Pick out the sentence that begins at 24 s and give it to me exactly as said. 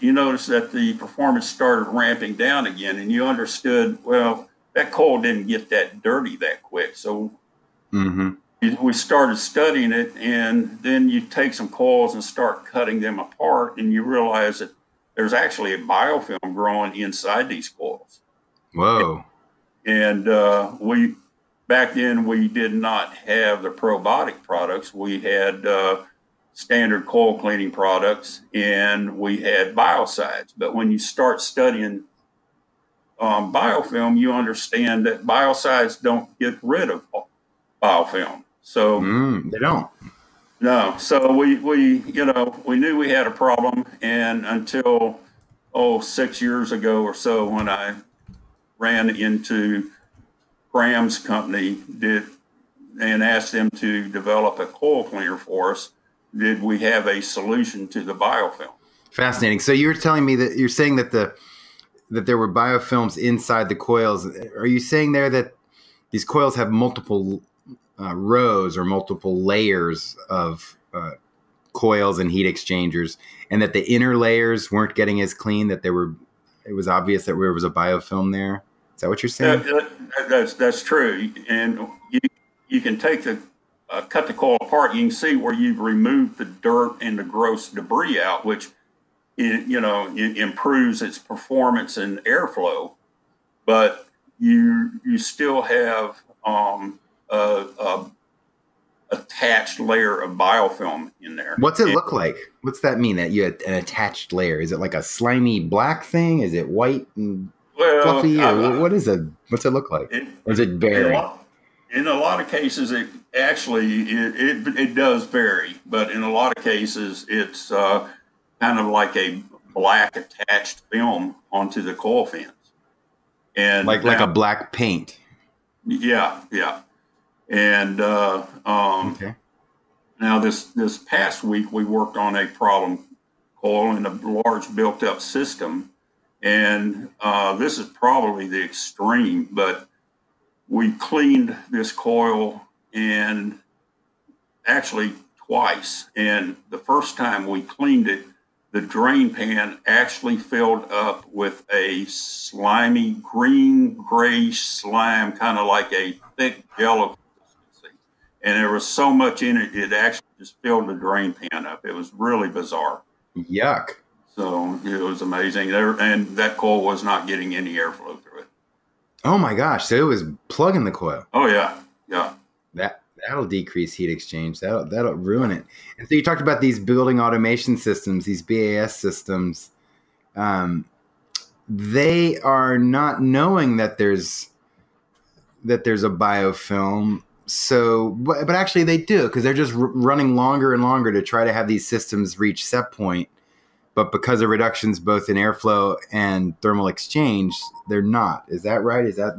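We had uh, standard coil cleaning products and we had biocides.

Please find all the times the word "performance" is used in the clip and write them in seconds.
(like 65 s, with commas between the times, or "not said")
0 s, 91 s.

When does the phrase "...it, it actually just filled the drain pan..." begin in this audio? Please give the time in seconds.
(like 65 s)
159 s.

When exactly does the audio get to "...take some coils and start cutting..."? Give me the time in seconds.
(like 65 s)
11 s.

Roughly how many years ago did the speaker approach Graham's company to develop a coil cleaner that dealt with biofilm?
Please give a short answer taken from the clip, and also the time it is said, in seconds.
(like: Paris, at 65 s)
6, at 45 s.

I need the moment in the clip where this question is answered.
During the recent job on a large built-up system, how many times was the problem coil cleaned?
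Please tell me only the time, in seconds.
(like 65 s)
145 s.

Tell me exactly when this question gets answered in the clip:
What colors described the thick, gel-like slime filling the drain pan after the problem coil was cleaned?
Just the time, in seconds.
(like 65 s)
153 s.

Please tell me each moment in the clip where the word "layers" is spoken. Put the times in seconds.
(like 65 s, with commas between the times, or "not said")
69 s, 74 s, 99 s, 104 s.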